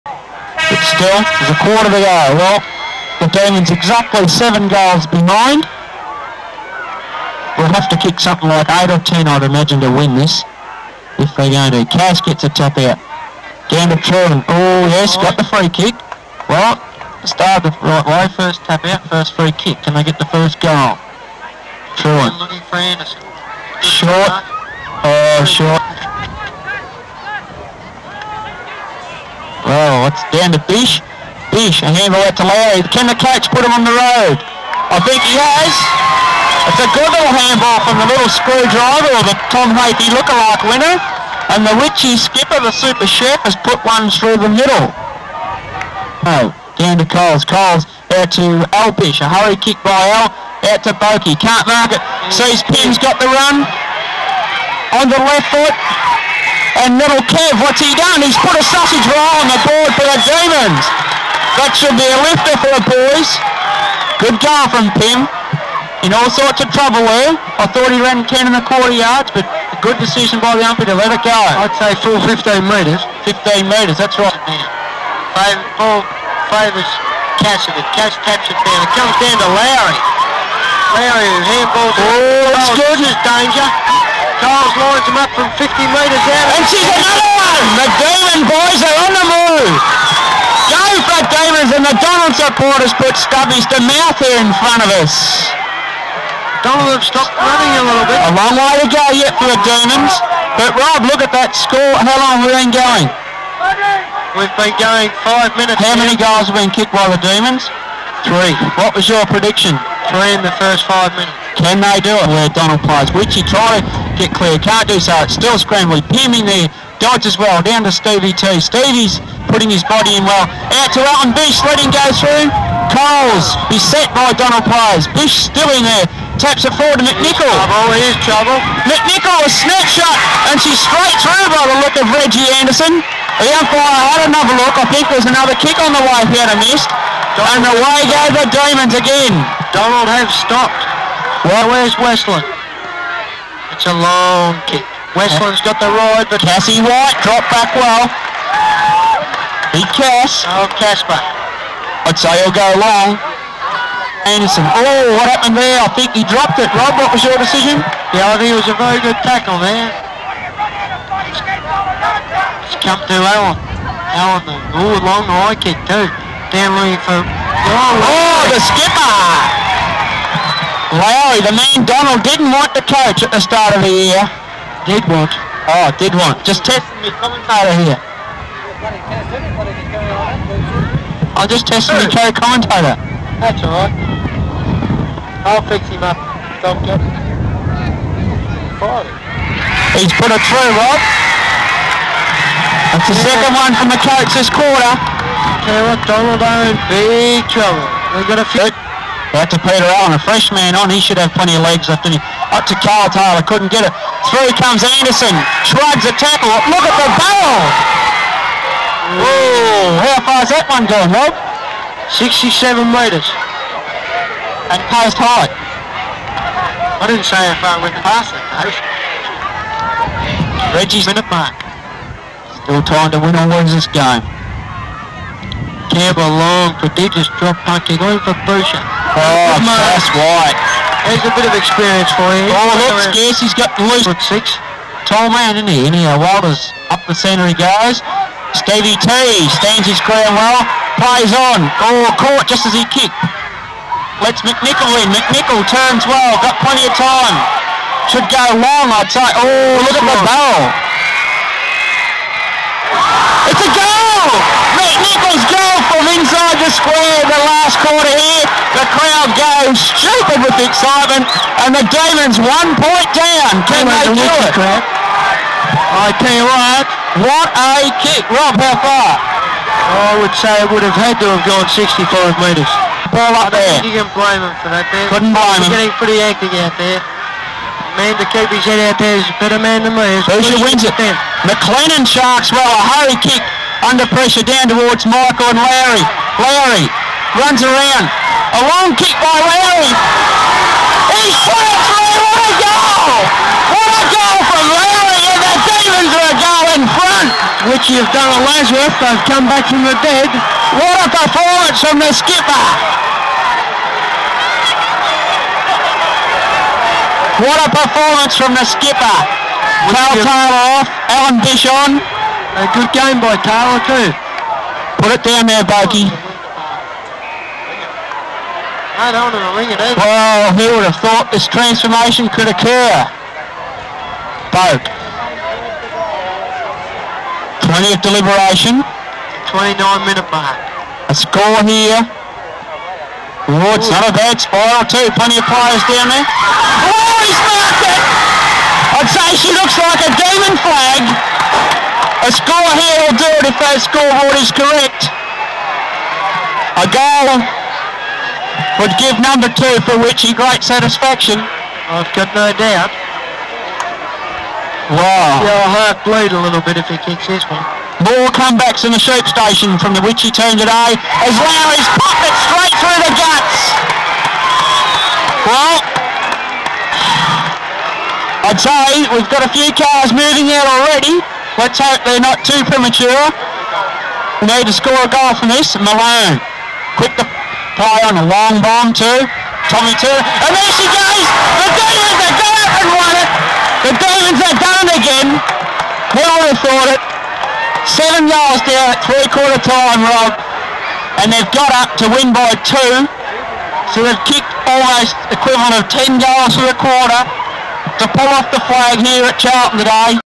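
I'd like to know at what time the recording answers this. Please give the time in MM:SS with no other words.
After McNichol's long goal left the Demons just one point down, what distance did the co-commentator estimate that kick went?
04:31.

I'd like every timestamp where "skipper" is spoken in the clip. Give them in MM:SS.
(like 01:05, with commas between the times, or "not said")
00:42, 02:48, 05:02, 05:08.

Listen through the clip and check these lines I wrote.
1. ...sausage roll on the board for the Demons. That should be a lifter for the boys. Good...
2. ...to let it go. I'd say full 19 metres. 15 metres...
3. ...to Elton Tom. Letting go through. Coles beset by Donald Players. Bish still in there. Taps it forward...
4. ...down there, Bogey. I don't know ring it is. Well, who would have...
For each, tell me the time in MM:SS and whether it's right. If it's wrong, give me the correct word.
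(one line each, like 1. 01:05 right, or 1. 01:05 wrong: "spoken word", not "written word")
1. 00:58 right
2. 01:10 wrong: "15", not "19"
3. 02:00 wrong: "Bish", not "Tom"
4. 05:15 right.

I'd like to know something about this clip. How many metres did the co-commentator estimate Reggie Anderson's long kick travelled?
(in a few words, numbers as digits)
67 metres.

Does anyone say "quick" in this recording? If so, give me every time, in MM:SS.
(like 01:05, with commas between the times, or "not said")
06:16.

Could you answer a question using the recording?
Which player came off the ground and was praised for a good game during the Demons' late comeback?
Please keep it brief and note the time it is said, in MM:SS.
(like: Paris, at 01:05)
Cal Taylor, at 05:09.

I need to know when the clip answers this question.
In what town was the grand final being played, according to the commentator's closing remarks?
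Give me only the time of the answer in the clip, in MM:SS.
06:39.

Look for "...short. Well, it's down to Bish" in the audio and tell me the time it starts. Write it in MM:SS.
00:25.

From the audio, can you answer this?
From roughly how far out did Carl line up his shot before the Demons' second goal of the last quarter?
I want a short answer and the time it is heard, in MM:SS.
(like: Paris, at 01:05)
50 metres, at 01:25.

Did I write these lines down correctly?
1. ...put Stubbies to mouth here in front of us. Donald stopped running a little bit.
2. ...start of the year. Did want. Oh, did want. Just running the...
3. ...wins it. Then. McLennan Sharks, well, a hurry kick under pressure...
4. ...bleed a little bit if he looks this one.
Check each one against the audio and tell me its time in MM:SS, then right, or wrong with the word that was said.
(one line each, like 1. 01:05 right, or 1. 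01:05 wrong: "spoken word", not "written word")
1. 01:32 right
2. 02:53 wrong: "testing", not "running"
3. 04:40 right
4. 05:56 wrong: "kicks", not "looks".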